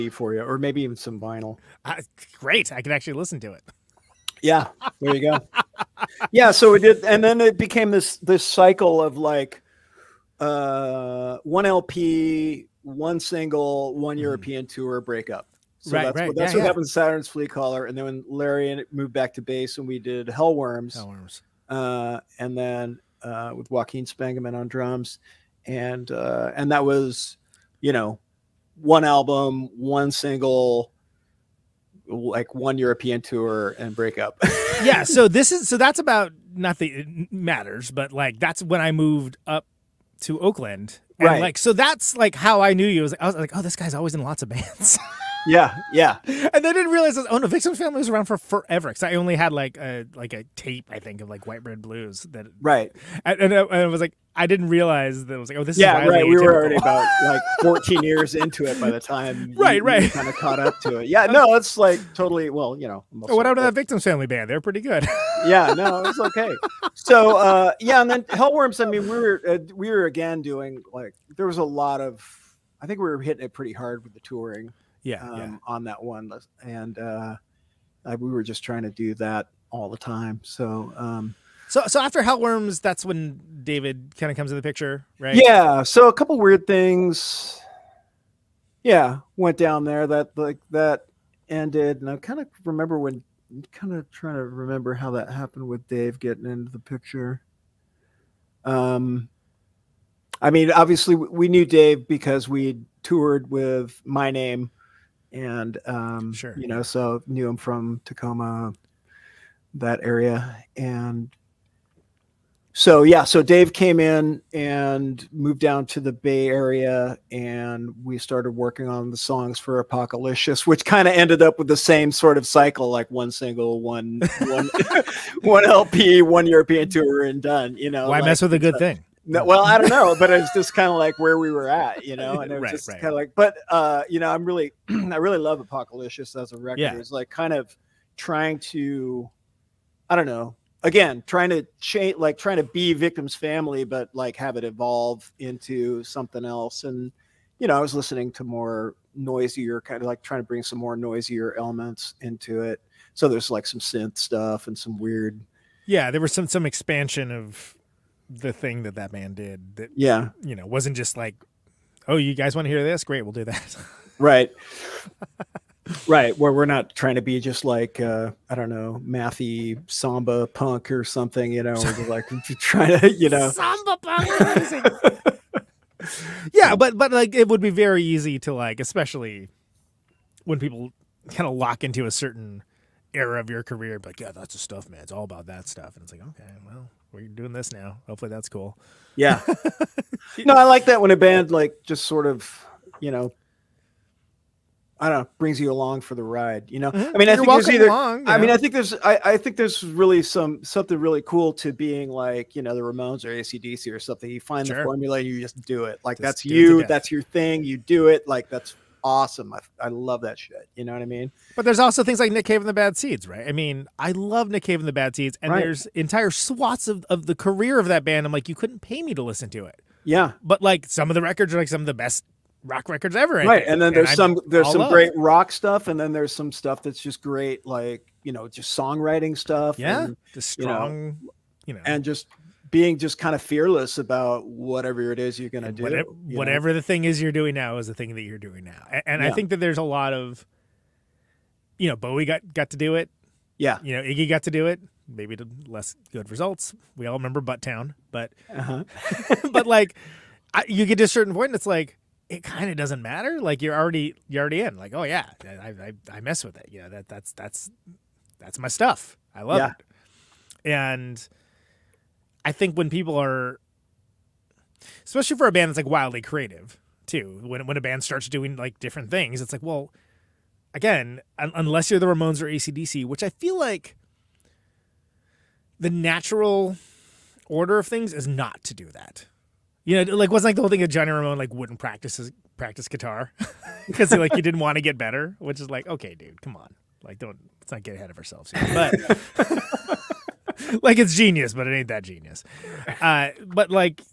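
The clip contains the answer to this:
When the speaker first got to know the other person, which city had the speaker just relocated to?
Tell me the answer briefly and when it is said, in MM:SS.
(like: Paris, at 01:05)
Oakland, at 00:40.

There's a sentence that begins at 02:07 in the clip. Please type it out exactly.
You know, why like, mess with a good thing?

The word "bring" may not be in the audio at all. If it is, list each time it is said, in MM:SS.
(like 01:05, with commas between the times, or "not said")
02:30, 03:15.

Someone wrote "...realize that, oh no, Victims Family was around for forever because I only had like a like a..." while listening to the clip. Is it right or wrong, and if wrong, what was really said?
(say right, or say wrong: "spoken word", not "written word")
right.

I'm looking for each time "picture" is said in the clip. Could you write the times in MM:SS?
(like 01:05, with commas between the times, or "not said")
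01:24, 01:36.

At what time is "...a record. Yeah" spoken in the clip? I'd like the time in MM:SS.
02:16.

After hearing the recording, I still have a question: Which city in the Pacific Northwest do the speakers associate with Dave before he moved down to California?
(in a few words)
Tacoma.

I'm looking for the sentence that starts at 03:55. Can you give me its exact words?
Whatever, whatever, the thing is you're doing now is the thing that you're doing now.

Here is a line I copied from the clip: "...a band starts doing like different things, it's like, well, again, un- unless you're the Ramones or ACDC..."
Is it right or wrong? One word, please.
right.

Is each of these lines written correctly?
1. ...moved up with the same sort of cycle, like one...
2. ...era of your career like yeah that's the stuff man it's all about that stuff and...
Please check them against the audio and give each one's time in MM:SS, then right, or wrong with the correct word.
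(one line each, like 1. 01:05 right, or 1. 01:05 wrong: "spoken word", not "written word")
1. 02:01 wrong: "ended", not "moved"
2. 03:03 right.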